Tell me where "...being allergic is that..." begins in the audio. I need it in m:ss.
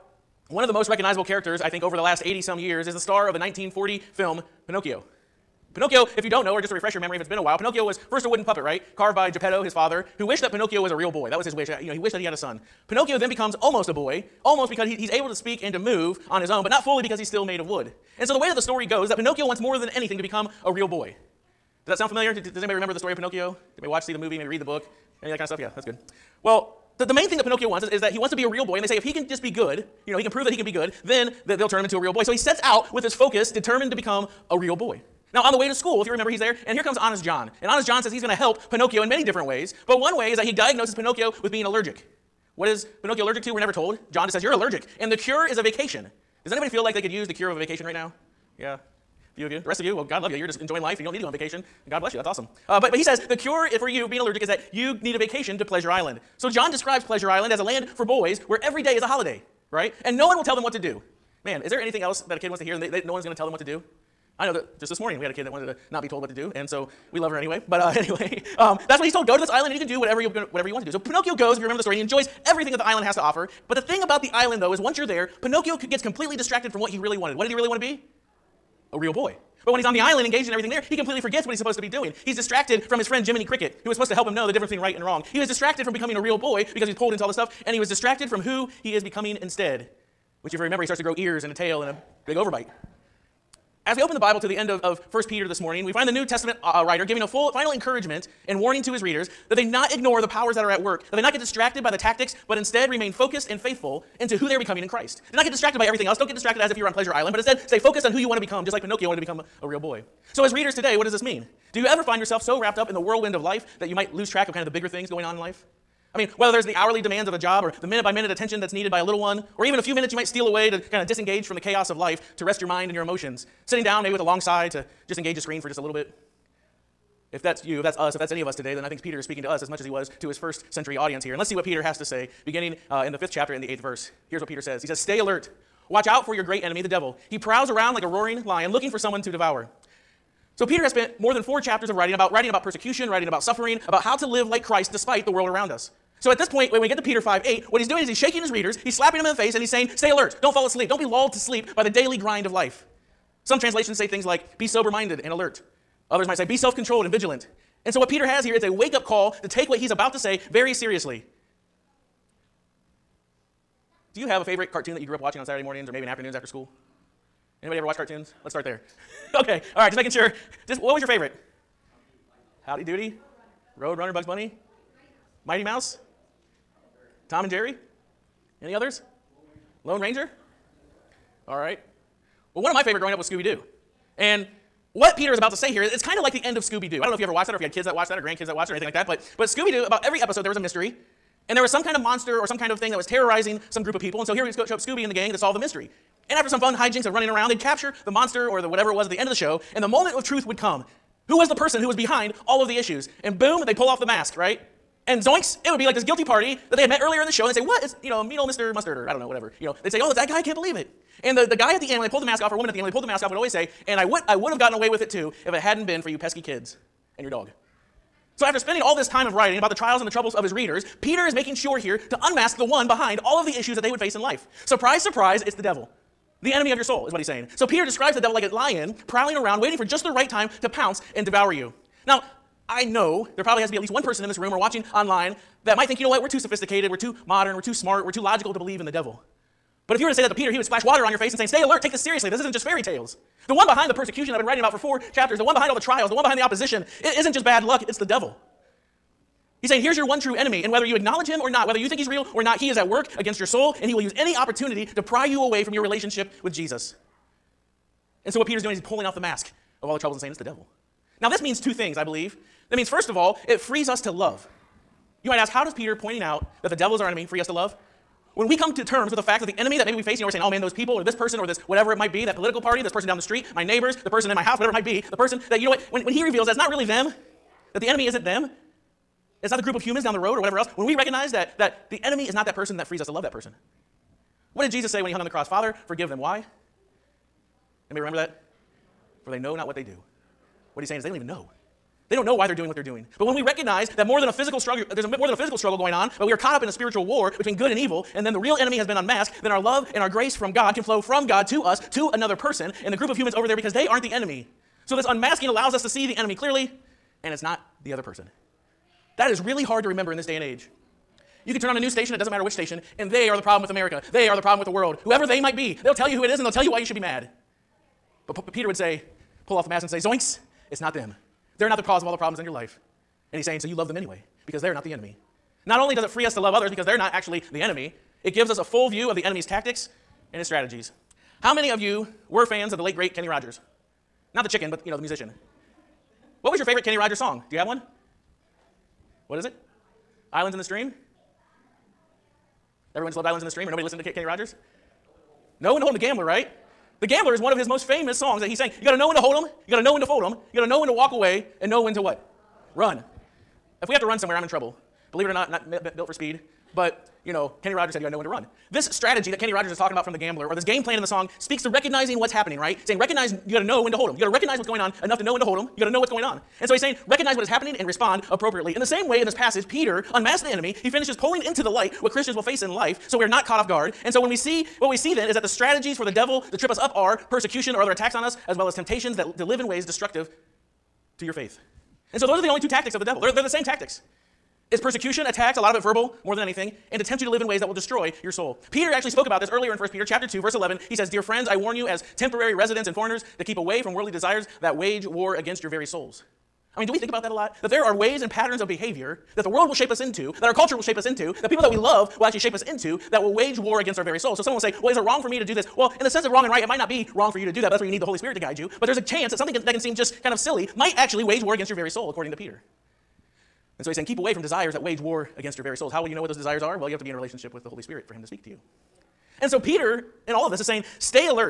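0:54.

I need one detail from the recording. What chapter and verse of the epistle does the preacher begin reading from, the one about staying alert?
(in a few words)
Chapter 5, verse 8.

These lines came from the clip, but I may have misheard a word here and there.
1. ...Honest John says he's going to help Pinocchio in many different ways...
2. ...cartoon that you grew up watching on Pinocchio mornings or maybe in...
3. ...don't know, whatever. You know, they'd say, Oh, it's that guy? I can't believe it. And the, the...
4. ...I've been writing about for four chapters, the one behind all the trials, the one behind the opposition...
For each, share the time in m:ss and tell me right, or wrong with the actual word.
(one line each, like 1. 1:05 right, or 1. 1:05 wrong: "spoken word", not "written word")
1. 0:37 right
2. 2:44 wrong: "Saturday", not "Pinocchio"
3. 3:29 right
4. 4:04 right.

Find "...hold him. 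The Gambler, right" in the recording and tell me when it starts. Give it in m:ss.
5:45.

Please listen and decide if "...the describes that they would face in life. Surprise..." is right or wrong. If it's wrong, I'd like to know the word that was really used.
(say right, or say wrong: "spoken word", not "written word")
wrong: "issues", not "describes".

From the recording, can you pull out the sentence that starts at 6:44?
So someone will say, Well, is it wrong for me to do this?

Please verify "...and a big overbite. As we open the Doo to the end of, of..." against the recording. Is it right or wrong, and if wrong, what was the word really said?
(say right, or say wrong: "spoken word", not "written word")
wrong: "Bible", not "Doo".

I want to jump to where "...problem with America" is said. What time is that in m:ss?
5:13.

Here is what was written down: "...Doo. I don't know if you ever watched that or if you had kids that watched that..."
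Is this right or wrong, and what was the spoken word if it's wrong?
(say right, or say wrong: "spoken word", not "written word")
right.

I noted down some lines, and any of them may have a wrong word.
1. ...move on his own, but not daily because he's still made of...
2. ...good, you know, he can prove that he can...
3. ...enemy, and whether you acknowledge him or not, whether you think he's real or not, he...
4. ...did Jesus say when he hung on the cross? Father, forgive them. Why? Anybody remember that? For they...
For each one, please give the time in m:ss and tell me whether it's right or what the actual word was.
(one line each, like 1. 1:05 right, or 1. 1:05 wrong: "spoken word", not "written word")
1. 0:15 wrong: "fully", not "daily"
2. 0:29 right
3. 4:10 right
4. 4:44 right.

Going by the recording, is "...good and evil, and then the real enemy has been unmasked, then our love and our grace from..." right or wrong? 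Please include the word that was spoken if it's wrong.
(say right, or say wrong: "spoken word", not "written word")
right.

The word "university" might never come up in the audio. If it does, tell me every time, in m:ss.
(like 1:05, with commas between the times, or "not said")
not said.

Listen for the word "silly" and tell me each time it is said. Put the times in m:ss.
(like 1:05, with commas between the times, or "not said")
6:50.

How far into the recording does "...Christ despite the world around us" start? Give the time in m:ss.
2:24.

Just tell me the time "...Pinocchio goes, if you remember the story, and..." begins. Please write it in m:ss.
1:10.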